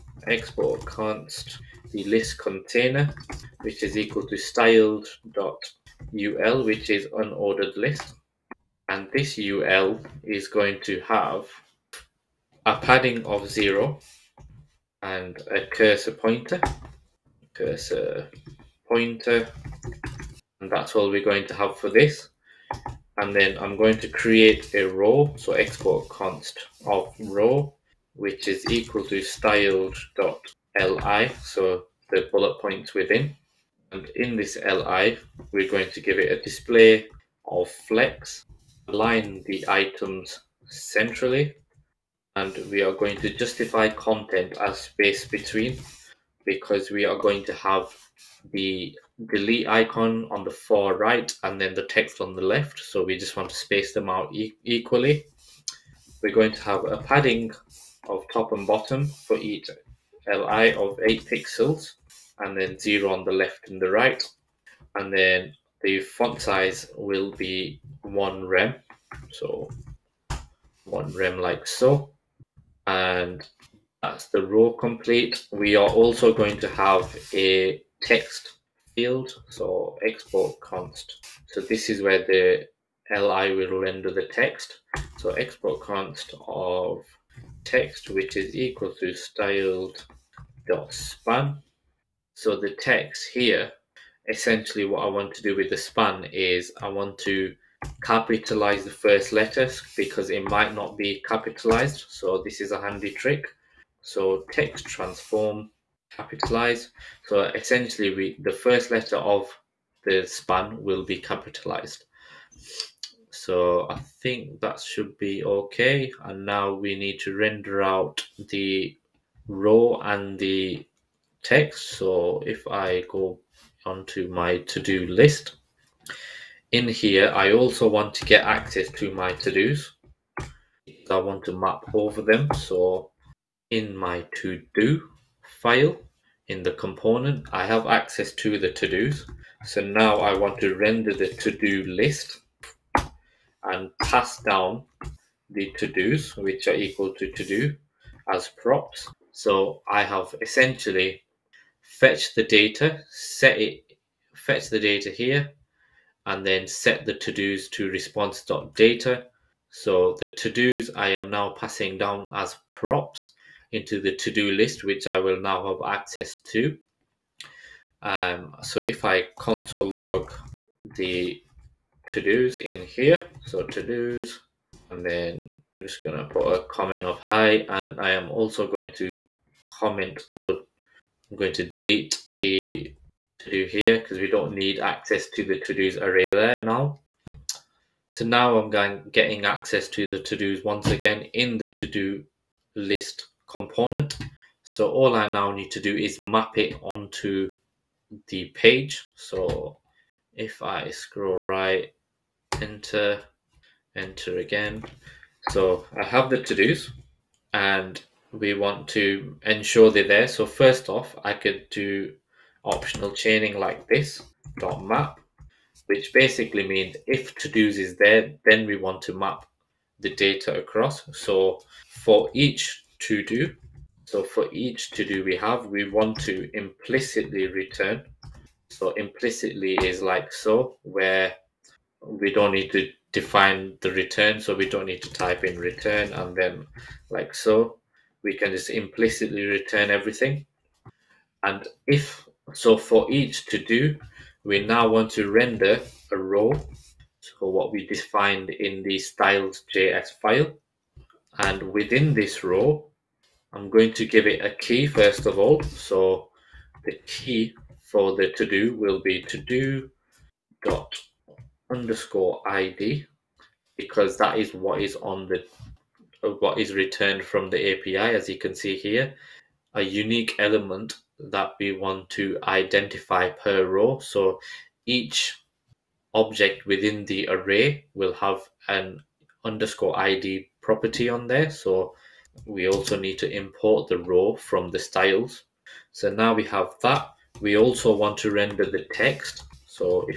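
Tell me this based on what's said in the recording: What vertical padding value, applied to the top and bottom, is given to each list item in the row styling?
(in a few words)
8 pixels.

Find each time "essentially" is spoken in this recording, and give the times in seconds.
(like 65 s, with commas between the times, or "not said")
94 s, 107 s, 150 s.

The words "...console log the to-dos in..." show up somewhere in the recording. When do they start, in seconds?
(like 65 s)
169 s.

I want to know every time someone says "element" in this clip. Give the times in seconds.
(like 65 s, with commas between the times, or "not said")
270 s.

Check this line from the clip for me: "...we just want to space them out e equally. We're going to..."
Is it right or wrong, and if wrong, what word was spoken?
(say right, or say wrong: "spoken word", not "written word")
right.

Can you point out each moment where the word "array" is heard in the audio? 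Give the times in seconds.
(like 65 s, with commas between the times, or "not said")
186 s, 277 s.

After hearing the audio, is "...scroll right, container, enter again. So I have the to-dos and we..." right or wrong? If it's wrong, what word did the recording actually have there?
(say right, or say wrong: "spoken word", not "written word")
wrong: "enter", not "container".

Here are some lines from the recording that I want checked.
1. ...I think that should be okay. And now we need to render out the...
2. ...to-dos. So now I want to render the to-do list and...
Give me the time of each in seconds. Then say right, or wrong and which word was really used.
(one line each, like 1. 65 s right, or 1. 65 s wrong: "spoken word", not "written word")
1. 113 s right
2. 138 s right.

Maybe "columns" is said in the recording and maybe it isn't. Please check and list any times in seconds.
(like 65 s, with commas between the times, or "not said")
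not said.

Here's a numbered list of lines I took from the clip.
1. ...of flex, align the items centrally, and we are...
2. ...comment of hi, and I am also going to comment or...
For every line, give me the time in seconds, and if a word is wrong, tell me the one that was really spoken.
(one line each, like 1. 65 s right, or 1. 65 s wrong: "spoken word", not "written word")
1. 37 s right
2. 176 s right.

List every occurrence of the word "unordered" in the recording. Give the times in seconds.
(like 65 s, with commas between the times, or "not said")
7 s.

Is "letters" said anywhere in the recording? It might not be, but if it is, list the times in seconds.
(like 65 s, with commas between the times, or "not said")
99 s, 108 s.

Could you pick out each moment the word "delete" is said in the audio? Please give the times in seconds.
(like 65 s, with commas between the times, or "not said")
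49 s, 181 s.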